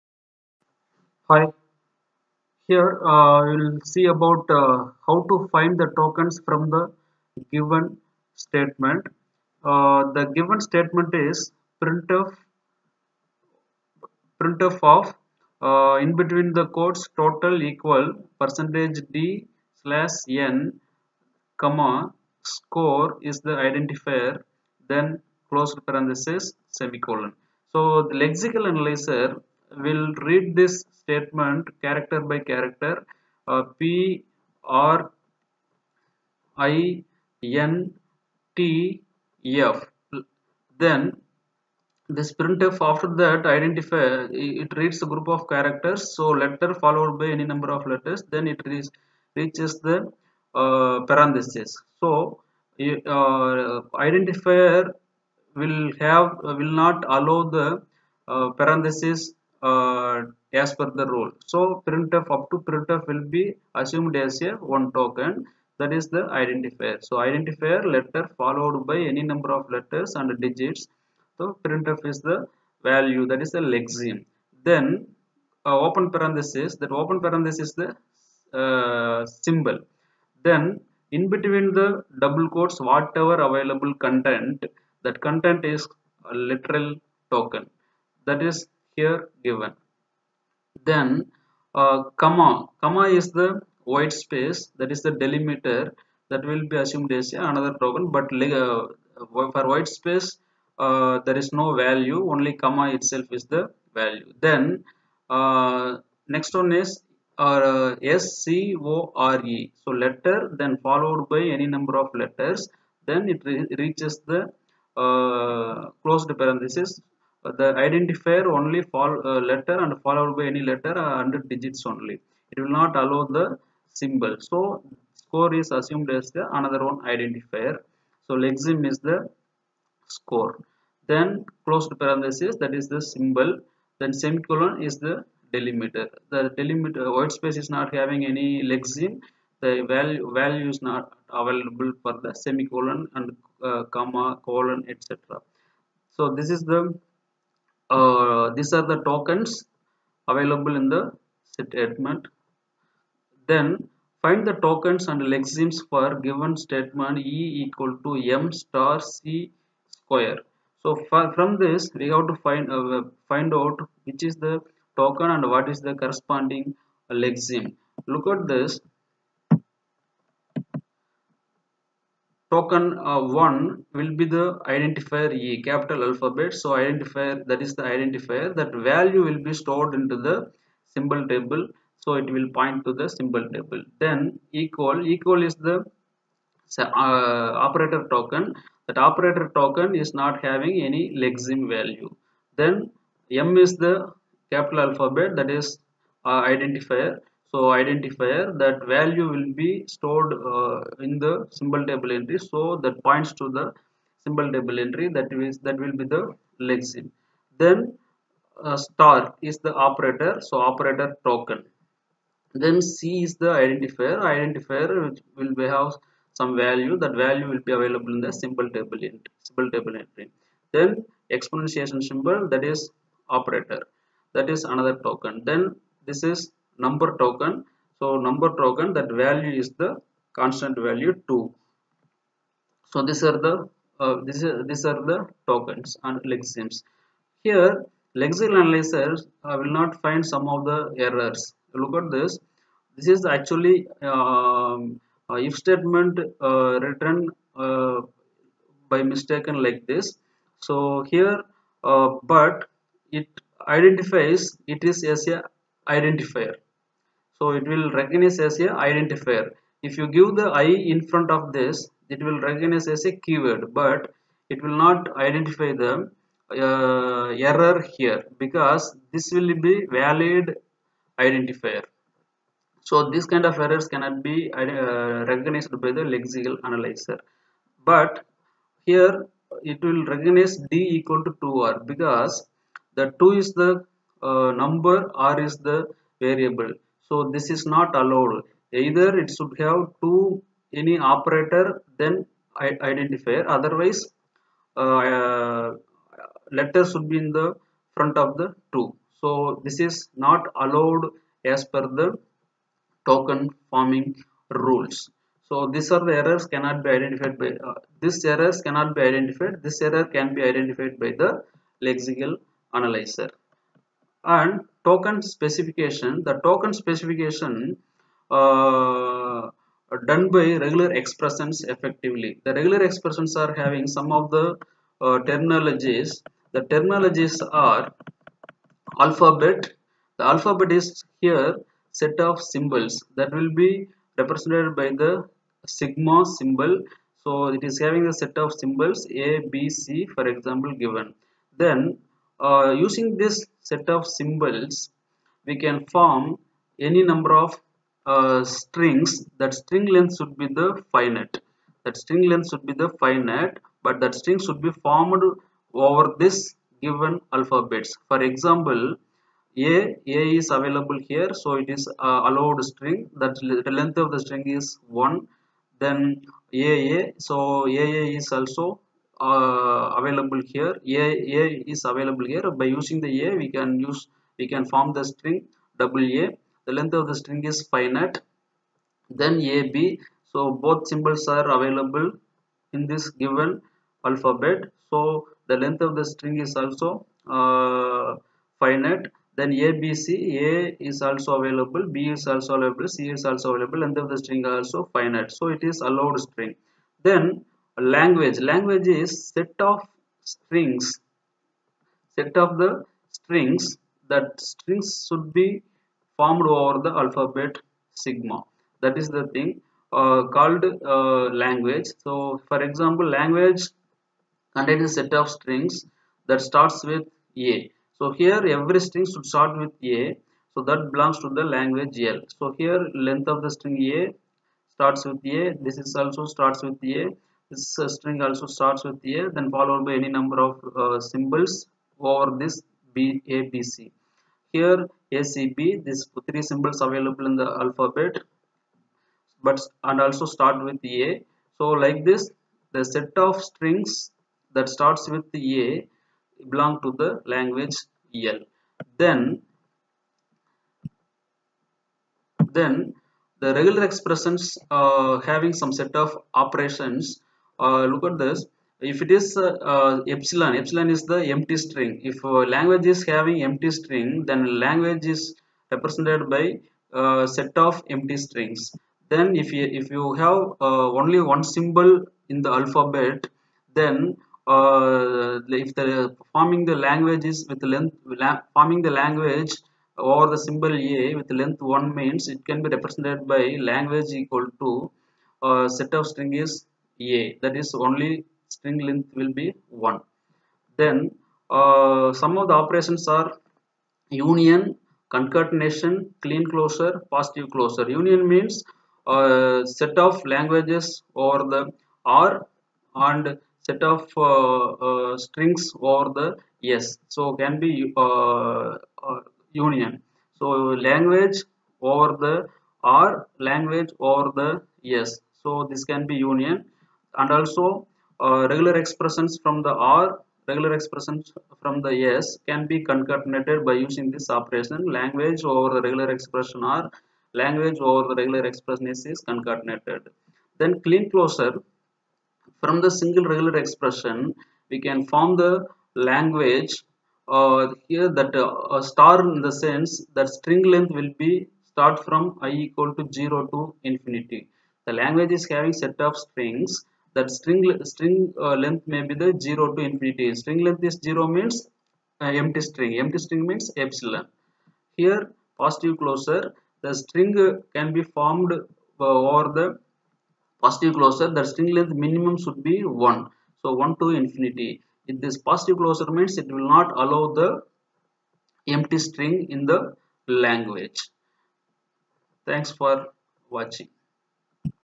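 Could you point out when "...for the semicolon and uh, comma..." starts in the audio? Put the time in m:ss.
2:22.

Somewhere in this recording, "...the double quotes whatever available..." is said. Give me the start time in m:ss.
1:21.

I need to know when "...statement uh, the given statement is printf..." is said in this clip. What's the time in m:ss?
0:08.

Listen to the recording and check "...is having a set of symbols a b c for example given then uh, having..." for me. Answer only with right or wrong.
wrong.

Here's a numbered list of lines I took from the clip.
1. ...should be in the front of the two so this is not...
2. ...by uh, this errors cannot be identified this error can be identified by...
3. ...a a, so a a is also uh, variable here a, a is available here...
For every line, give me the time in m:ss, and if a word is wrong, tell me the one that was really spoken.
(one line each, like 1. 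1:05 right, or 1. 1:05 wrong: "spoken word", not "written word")
1. 4:56 right
2. 5:07 right
3. 6:06 wrong: "available", not "variable".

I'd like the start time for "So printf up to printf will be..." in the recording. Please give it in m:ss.
1:01.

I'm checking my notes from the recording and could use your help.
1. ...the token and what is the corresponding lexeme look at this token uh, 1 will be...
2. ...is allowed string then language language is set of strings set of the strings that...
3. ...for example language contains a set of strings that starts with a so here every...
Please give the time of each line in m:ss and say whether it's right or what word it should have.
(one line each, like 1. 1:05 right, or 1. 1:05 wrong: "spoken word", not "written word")
1. 2:44 right
2. 6:35 right
3. 6:52 right.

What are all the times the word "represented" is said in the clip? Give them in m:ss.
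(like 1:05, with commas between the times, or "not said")
5:34, 7:45, 8:02.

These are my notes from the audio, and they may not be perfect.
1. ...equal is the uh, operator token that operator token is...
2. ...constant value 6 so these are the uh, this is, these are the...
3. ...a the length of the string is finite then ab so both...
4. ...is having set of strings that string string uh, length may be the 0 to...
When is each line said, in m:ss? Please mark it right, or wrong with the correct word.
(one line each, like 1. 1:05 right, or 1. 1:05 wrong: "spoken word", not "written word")
1. 3:05 right
2. 3:50 wrong: "2", not "6"
3. 6:16 right
4. 9:05 right.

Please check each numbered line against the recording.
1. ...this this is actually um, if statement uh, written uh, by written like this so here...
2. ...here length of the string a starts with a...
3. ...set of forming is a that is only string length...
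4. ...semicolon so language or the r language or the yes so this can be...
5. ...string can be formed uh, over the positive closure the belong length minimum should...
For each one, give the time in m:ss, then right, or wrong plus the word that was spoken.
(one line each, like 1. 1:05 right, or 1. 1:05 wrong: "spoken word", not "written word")
1. 4:02 wrong: "mistaken", not "written"
2. 7:02 right
3. 8:05 wrong: "string", not "forming"
4. 8:29 wrong: "union", not "semicolon"
5. 9:17 wrong: "string", not "belong".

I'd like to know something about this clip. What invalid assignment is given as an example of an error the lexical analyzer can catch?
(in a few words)
d = 2r.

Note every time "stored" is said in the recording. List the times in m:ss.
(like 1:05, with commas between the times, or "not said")
2:59, 3:19.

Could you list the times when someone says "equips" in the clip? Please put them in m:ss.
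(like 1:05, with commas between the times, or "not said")
not said.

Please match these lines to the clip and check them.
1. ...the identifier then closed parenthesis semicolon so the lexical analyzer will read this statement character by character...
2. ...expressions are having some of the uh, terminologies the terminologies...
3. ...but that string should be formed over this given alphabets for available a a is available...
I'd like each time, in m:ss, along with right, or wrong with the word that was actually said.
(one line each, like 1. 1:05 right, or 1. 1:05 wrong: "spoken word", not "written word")
1. 0:23 right
2. 5:22 right
3. 5:53 wrong: "example", not "available".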